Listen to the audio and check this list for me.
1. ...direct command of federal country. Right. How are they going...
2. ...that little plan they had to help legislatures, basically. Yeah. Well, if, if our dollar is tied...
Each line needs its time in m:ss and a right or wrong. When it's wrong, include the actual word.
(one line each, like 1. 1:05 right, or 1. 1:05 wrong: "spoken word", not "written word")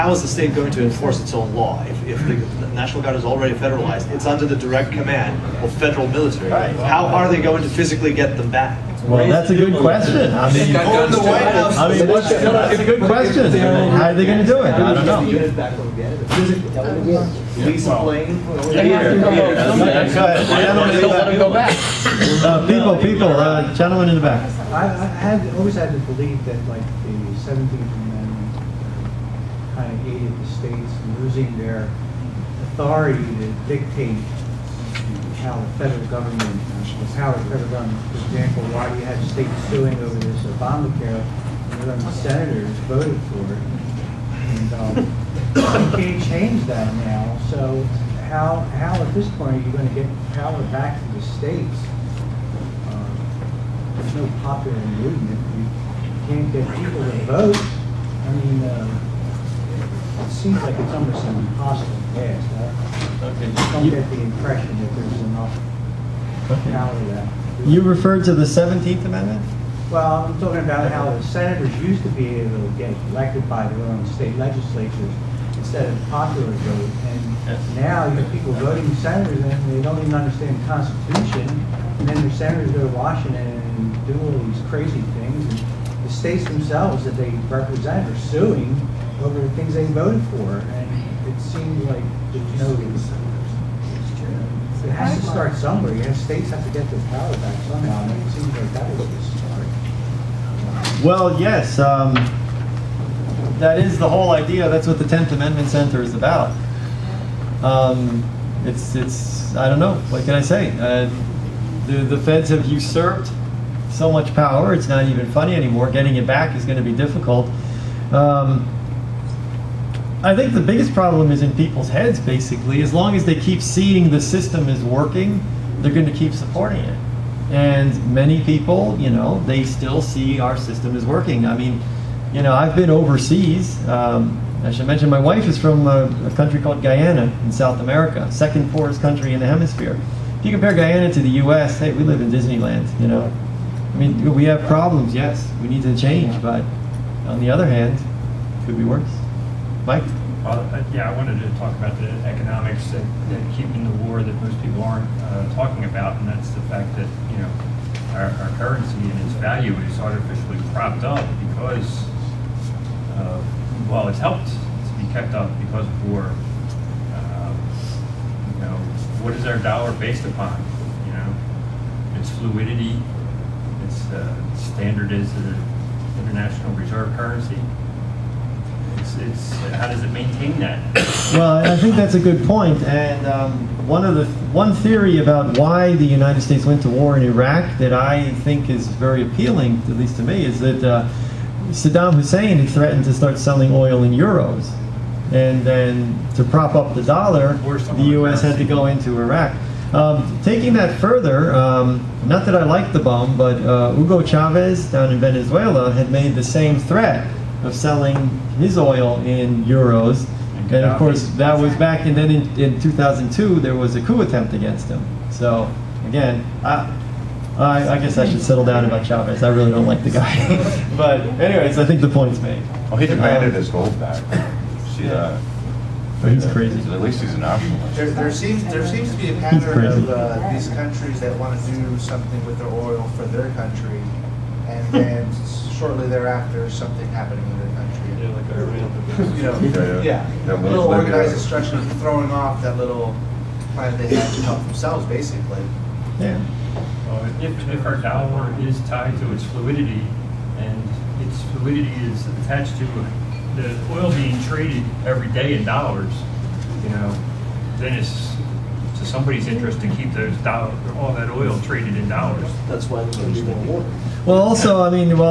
1. 0:04 wrong: "military", not "country"
2. 4:02 wrong: "themselves", not "legislatures".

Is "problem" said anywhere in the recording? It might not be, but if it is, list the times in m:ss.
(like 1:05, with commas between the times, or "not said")
2:00, 2:24.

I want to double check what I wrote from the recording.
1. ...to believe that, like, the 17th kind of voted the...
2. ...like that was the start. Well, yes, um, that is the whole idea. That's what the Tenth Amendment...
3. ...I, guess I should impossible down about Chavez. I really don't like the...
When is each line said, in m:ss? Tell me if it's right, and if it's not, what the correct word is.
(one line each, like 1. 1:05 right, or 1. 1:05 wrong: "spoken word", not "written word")
1. 0:25 wrong: "aided", not "voted"
2. 1:38 right
3. 3:37 wrong: "settle", not "impossible".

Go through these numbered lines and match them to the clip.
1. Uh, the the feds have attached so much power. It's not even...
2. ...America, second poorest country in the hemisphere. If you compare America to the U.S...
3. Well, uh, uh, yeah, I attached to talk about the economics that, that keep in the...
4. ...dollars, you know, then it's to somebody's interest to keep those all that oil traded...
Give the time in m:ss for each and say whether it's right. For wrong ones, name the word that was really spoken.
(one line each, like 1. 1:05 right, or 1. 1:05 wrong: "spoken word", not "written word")
1. 1:50 wrong: "usurped", not "attached"
2. 2:17 wrong: "Guyana", not "America"
3. 2:30 wrong: "wanted", not "attached"
4. 4:15 right.